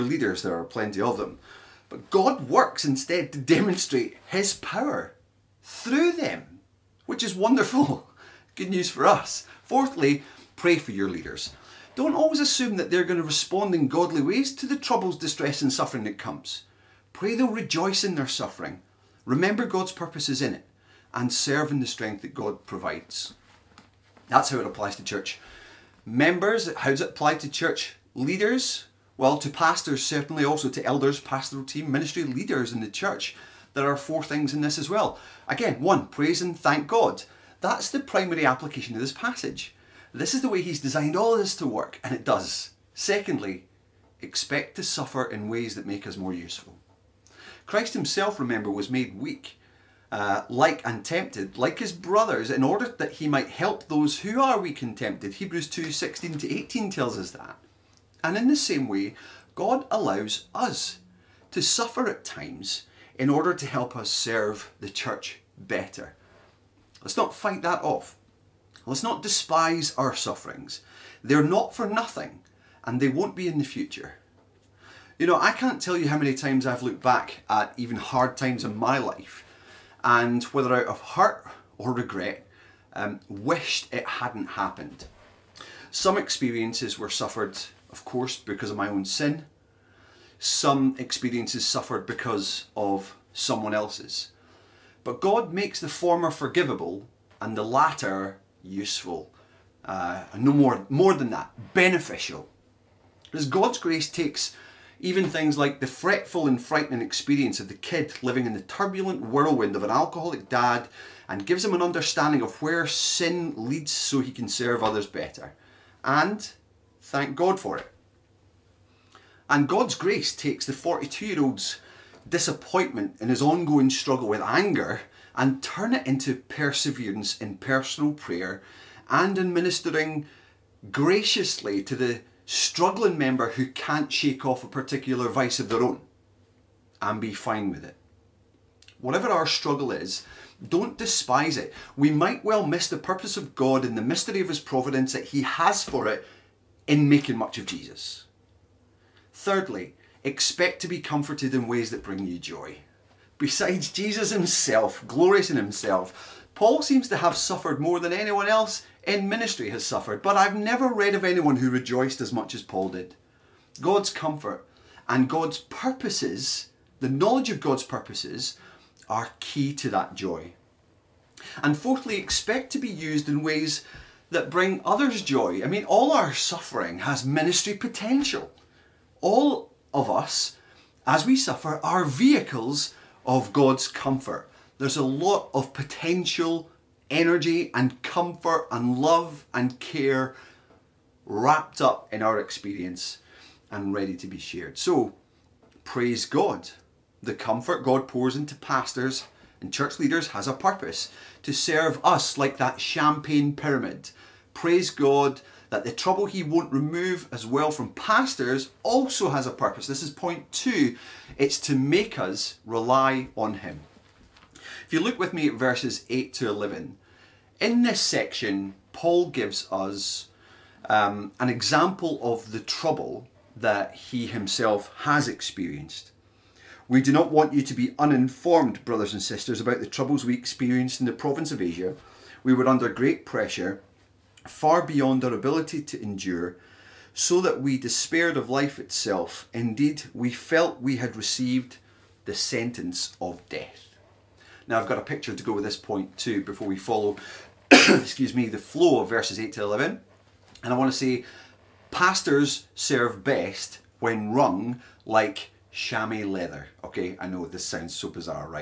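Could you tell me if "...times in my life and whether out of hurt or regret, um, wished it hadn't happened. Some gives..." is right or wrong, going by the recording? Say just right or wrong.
wrong.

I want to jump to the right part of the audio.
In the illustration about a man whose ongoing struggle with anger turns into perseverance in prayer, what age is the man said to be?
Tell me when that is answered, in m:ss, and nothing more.
2:00.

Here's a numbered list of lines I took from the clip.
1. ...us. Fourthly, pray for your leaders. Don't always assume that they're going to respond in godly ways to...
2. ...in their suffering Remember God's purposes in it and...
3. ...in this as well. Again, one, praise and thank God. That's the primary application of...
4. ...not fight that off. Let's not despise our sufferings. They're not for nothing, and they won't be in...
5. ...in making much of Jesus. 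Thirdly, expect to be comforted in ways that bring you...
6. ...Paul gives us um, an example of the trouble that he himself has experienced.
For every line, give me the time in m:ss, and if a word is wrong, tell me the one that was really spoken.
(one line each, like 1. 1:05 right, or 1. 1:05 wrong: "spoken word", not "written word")
1. 0:09 right
2. 0:18 right
3. 0:34 right
4. 1:07 right
5. 2:26 right
6. 3:38 right.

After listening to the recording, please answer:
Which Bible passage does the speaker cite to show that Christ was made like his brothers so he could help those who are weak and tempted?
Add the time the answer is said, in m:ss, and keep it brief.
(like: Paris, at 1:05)
Hebrews 2:16-18, at 0:55.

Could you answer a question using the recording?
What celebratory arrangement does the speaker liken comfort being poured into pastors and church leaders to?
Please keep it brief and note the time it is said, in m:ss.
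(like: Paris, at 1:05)
champagne pyramid, at 3:22.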